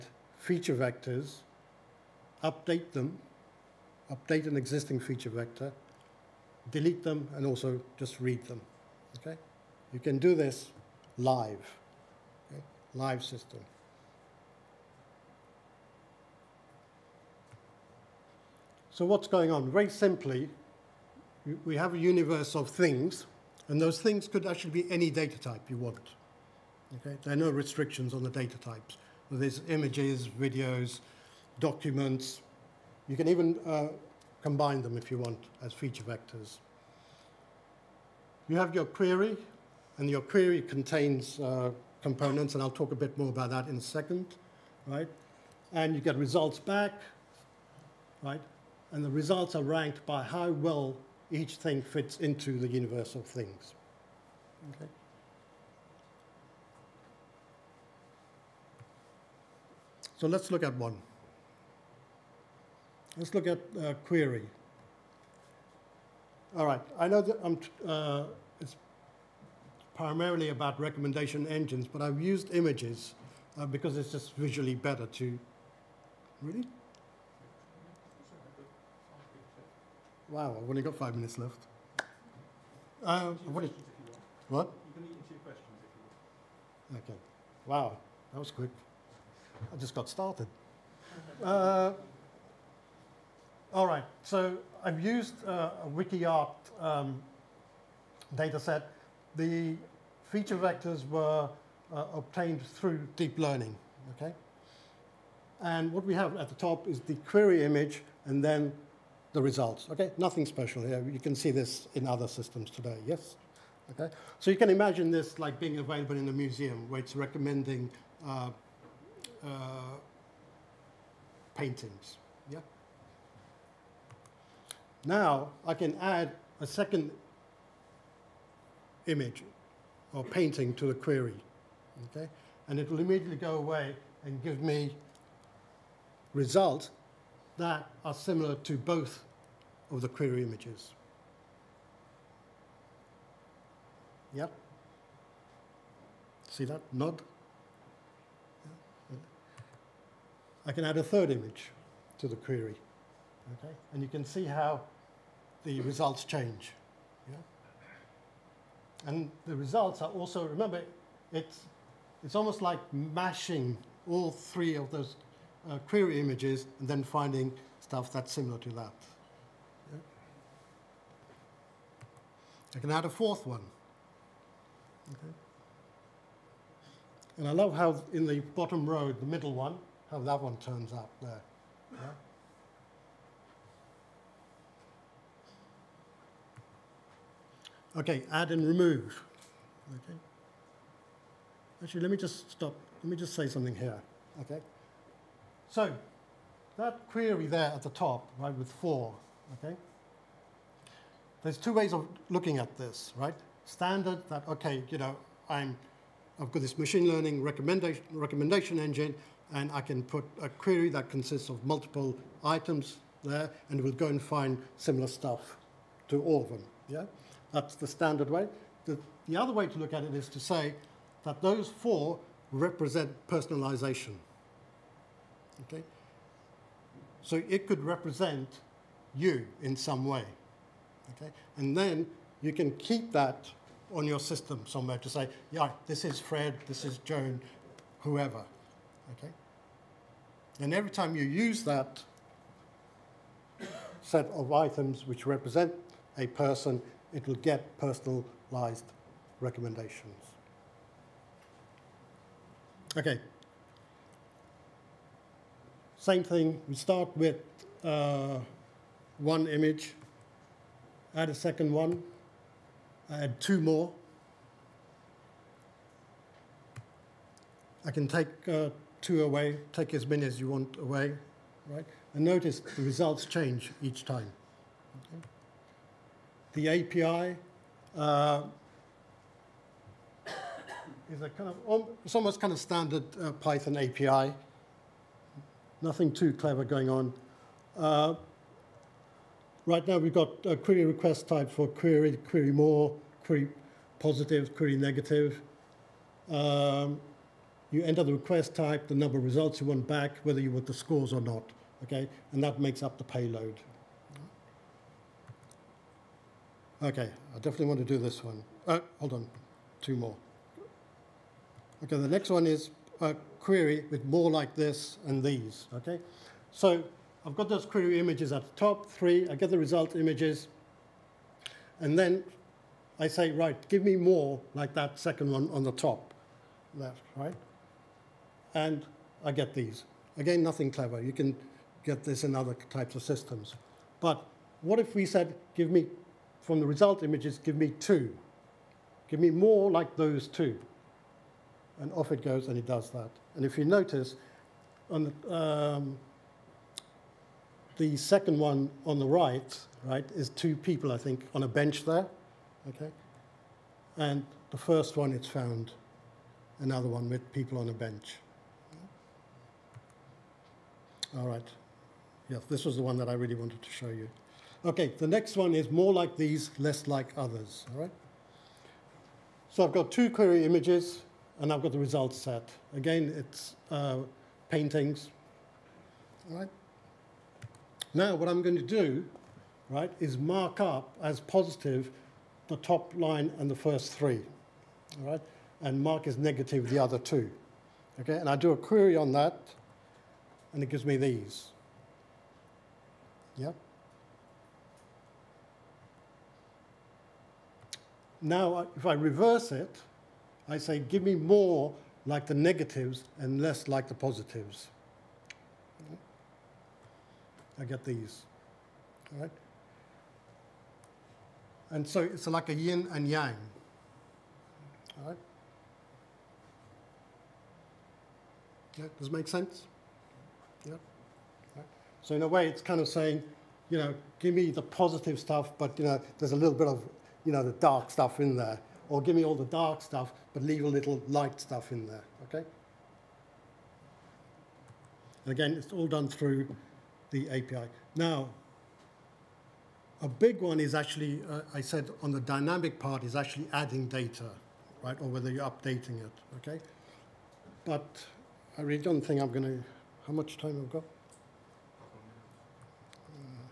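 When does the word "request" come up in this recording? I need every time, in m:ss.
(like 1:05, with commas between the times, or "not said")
4:50, 4:58.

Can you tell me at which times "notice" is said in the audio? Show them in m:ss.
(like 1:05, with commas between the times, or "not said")
4:32, 5:43.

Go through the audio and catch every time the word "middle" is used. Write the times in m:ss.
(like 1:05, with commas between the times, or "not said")
2:59.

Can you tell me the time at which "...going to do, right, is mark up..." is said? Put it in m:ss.
6:18.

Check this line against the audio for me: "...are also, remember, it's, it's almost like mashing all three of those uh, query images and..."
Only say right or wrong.
right.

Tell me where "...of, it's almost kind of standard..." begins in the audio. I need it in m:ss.
4:41.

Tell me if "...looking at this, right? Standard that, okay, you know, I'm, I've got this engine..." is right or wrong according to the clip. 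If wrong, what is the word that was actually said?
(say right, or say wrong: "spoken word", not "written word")
wrong: "machine", not "engine".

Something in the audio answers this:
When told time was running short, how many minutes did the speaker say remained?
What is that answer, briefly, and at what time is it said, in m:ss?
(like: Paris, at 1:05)
5, at 1:20.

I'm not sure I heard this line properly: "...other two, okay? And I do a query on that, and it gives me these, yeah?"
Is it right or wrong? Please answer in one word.
right.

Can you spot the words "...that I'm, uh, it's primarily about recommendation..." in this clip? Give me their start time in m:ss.
1:07.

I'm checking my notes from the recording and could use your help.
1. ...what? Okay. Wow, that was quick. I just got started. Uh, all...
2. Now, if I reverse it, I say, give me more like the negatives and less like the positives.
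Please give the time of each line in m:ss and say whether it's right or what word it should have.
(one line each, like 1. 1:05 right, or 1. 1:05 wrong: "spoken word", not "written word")
1. 1:24 right
2. 6:38 right.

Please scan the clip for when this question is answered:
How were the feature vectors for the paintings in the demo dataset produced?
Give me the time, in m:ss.
1:43.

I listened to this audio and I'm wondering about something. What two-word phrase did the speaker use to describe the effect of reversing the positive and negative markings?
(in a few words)
Yin and yang.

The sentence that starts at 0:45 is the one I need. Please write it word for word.
And you get results back, right?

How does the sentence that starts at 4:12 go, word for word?
Okay, same thing, we start with uh, one image, add a second one, add two more.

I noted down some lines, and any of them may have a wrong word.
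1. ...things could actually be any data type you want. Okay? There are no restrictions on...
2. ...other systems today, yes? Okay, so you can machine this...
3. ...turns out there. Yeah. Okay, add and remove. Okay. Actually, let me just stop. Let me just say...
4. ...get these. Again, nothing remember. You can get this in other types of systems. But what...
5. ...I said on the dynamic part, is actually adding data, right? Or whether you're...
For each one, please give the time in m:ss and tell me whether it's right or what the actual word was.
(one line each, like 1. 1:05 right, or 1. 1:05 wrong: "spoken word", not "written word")
1. 0:24 right
2. 1:52 wrong: "imagine", not "machine"
3. 3:00 right
4. 5:29 wrong: "clever", not "remember"
5. 7:21 right.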